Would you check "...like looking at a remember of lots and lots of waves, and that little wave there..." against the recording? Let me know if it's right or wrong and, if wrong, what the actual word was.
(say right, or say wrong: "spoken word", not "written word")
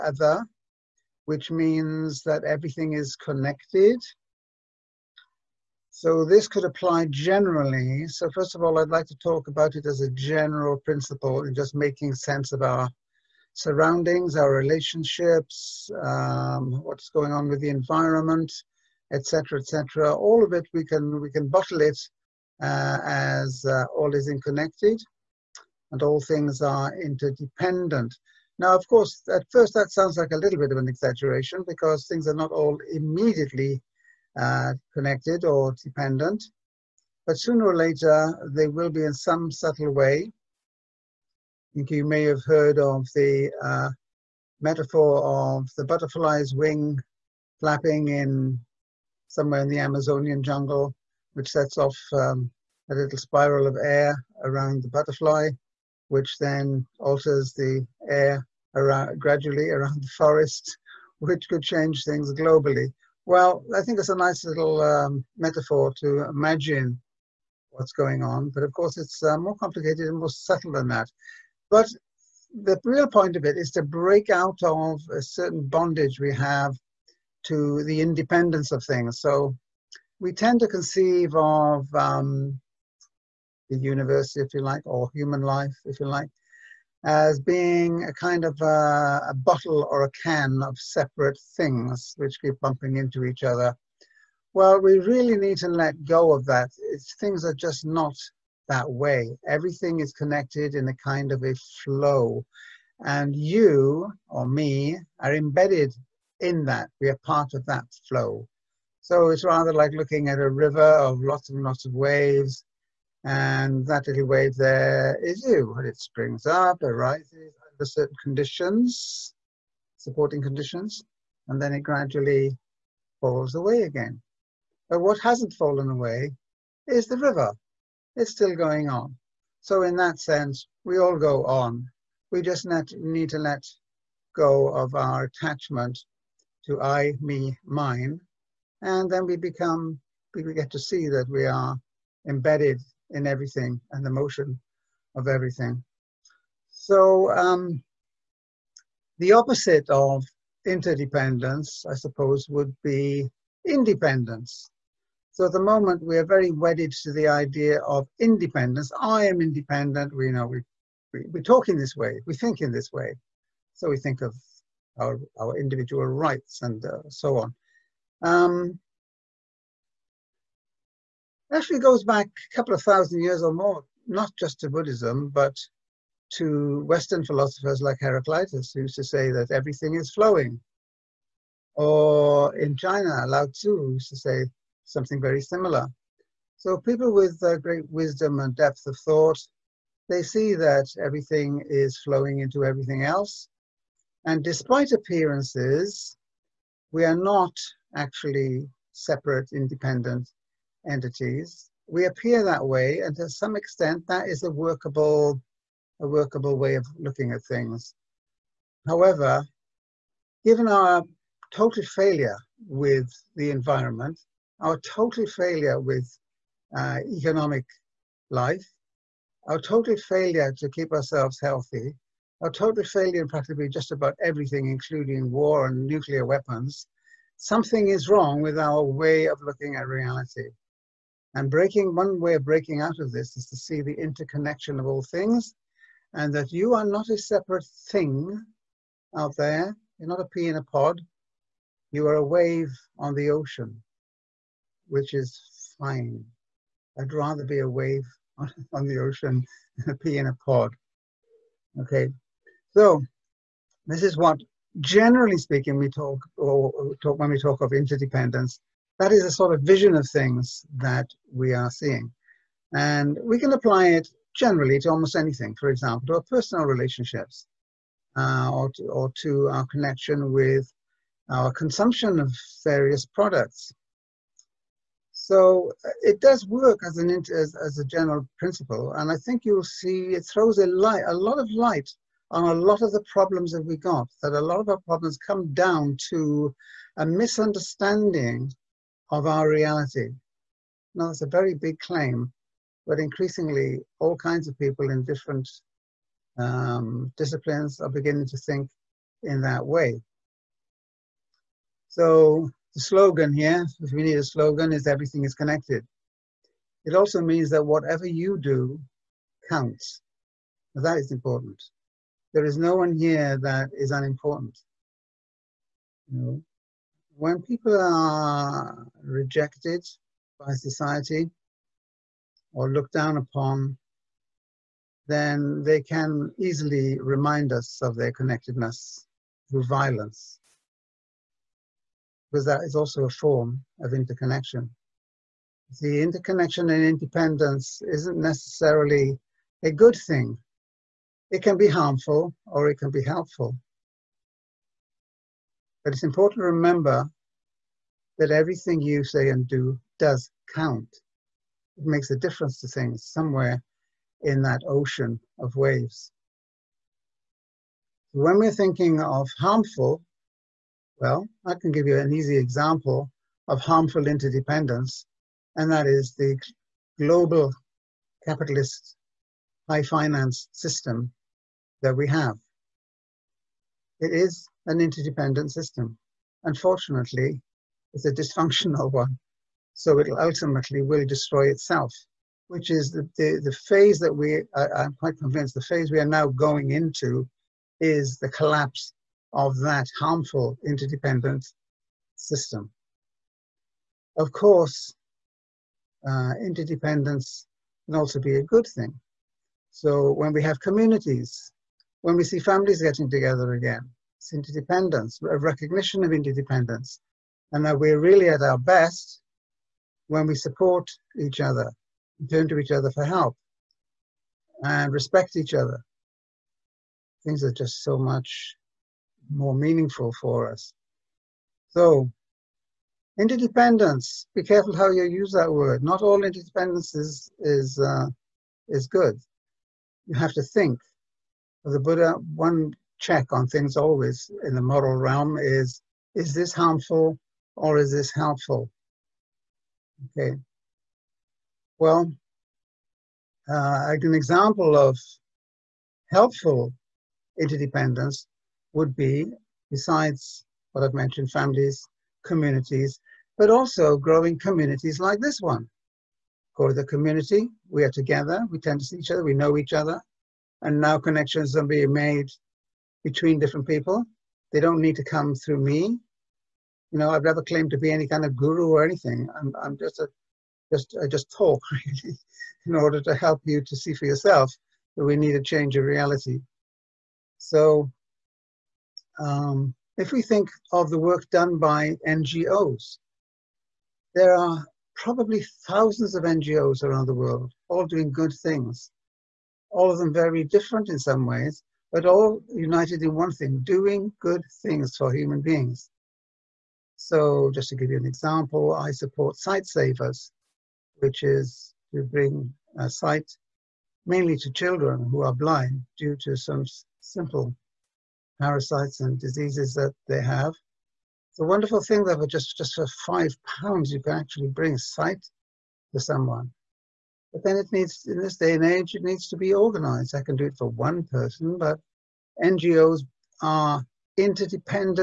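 wrong: "river", not "remember".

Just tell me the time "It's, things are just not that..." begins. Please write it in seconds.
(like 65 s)
96 s.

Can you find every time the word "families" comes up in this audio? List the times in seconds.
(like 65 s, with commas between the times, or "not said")
402 s, 451 s.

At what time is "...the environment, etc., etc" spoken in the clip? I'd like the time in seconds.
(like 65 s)
17 s.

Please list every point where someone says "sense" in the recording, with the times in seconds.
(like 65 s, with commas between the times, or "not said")
12 s, 130 s.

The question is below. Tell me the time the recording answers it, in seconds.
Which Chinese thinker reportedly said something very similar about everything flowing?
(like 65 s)
183 s.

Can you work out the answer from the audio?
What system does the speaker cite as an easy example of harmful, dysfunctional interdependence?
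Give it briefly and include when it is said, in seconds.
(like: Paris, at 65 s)
global capitalist high finance, at 366 s.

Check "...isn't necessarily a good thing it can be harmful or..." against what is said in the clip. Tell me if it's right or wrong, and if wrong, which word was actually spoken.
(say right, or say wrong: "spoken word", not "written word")
right.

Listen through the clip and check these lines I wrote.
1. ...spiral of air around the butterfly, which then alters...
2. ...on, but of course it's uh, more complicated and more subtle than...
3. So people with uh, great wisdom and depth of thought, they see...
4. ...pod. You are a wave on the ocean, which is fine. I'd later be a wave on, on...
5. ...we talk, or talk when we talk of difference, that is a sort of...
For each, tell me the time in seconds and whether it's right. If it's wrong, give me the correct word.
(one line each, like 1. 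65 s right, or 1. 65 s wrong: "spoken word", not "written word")
1. 53 s right
2. 68 s right
3. 186 s right
4. 240 s wrong: "rather", not "later"
5. 255 s wrong: "interdependence", not "difference".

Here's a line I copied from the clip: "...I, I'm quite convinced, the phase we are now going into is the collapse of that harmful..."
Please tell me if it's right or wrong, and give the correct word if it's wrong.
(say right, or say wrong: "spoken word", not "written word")
right.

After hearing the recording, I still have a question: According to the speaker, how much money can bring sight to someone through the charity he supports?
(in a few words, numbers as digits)
5 pounds.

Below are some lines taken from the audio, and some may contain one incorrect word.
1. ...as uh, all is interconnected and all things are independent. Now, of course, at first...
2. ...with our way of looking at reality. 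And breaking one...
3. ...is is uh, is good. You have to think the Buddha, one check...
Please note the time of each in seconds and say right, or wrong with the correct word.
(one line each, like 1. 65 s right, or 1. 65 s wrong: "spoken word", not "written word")
1. 23 s wrong: "interdependent", not "independent"
2. 228 s right
3. 426 s right.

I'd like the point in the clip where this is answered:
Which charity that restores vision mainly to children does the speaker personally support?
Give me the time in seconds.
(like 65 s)
499 s.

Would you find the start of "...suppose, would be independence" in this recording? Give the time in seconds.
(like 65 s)
151 s.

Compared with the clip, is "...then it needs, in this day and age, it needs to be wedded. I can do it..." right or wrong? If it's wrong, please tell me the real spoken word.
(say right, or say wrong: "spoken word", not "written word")
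wrong: "organized", not "wedded".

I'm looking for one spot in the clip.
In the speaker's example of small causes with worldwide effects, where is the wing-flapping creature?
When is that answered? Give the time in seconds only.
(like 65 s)
49 s.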